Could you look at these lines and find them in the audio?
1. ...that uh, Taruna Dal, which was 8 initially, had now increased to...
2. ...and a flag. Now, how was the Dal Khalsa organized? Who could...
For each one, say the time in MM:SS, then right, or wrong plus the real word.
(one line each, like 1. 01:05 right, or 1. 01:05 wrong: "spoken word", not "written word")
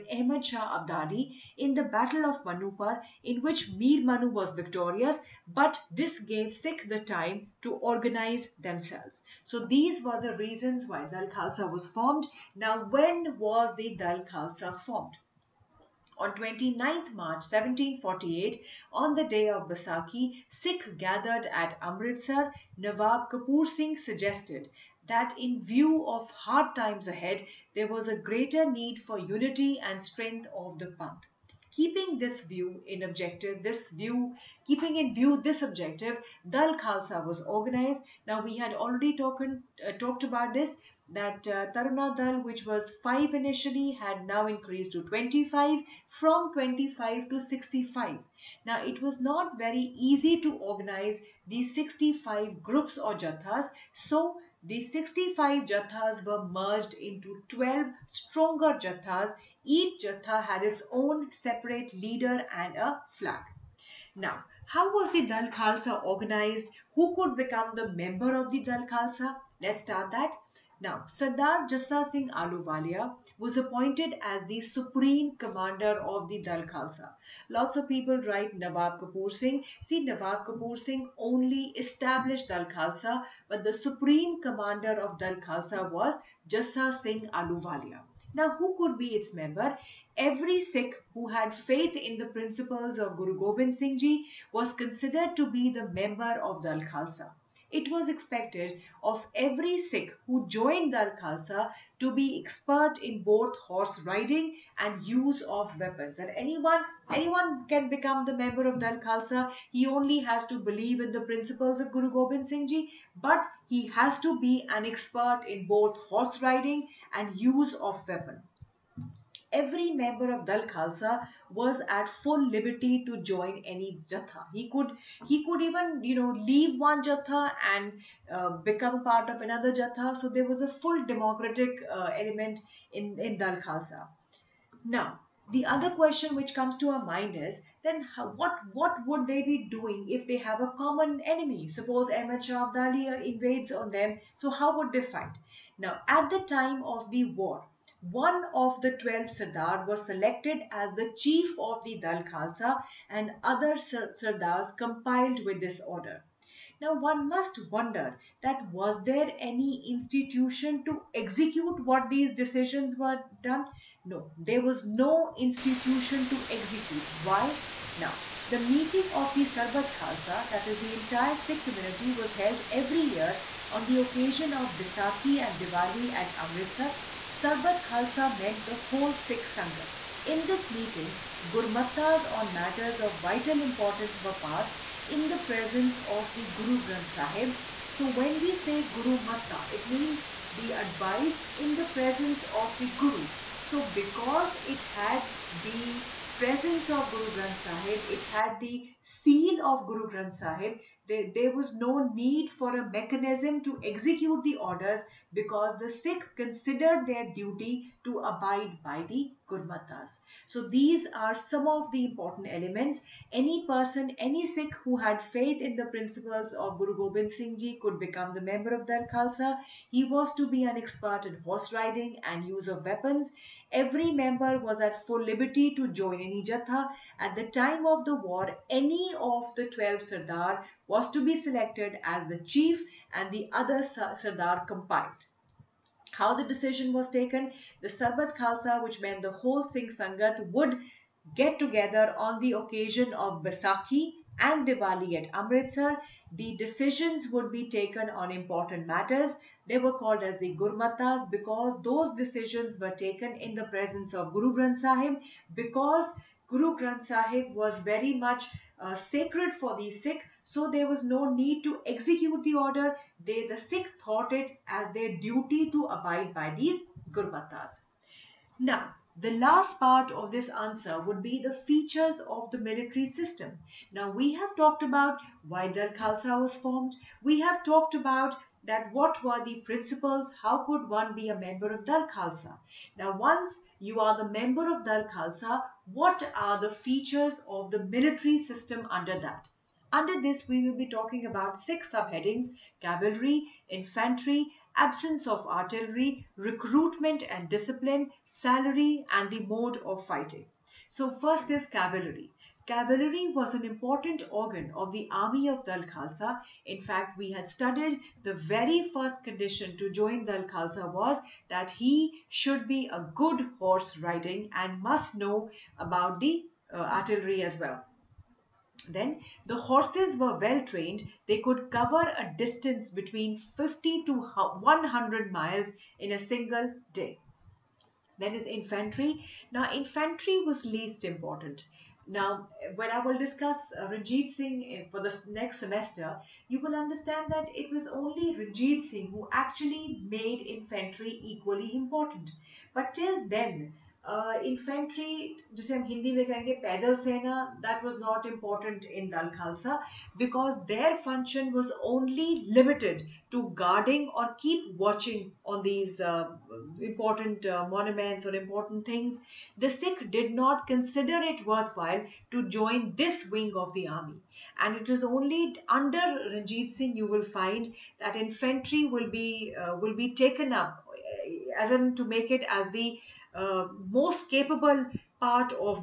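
1. 00:41 wrong: "5", not "8"
2. 01:02 right.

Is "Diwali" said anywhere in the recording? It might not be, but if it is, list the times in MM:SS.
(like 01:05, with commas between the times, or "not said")
02:55, 04:04.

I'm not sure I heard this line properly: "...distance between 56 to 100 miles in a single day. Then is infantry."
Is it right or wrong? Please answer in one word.
wrong.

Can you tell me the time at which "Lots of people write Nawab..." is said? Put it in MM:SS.
01:17.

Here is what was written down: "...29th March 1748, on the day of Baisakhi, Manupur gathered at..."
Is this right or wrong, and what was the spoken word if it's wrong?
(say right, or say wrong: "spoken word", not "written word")
wrong: "Sikh", not "Manupur".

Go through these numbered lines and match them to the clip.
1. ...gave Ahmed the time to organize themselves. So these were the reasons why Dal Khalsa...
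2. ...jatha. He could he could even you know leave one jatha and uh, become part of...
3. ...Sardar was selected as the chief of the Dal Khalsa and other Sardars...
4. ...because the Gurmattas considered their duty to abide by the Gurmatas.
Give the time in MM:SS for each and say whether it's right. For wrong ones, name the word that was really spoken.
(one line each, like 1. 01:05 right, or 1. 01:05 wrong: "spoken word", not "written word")
1. 00:06 wrong: "Sikh", not "Ahmed"
2. 02:04 right
3. 02:29 right
4. 03:25 wrong: "Sikh", not "Gurmattas".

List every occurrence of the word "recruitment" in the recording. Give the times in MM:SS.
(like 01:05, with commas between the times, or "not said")
04:56.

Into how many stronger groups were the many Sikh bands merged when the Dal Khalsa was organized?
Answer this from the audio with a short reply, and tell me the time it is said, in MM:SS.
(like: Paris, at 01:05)
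12, at 00:57.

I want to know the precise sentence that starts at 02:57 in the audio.
Sarbat Khalsa meant the whole Sikh Sangat.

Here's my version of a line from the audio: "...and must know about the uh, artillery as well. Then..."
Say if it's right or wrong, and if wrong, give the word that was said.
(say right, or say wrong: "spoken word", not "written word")
right.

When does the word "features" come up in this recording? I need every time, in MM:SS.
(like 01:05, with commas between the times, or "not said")
04:31, 04:46.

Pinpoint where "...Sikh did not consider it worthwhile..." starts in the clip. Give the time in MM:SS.
05:59.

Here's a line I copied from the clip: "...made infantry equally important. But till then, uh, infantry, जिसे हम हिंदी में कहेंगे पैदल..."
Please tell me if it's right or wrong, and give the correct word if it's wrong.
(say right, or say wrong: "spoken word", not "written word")
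right.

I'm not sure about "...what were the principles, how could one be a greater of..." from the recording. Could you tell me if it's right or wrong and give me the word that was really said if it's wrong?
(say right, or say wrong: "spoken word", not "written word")
wrong: "member", not "greater".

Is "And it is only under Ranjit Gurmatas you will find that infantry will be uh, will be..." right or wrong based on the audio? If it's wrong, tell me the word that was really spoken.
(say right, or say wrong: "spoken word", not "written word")
wrong: "Singh", not "Gurmatas".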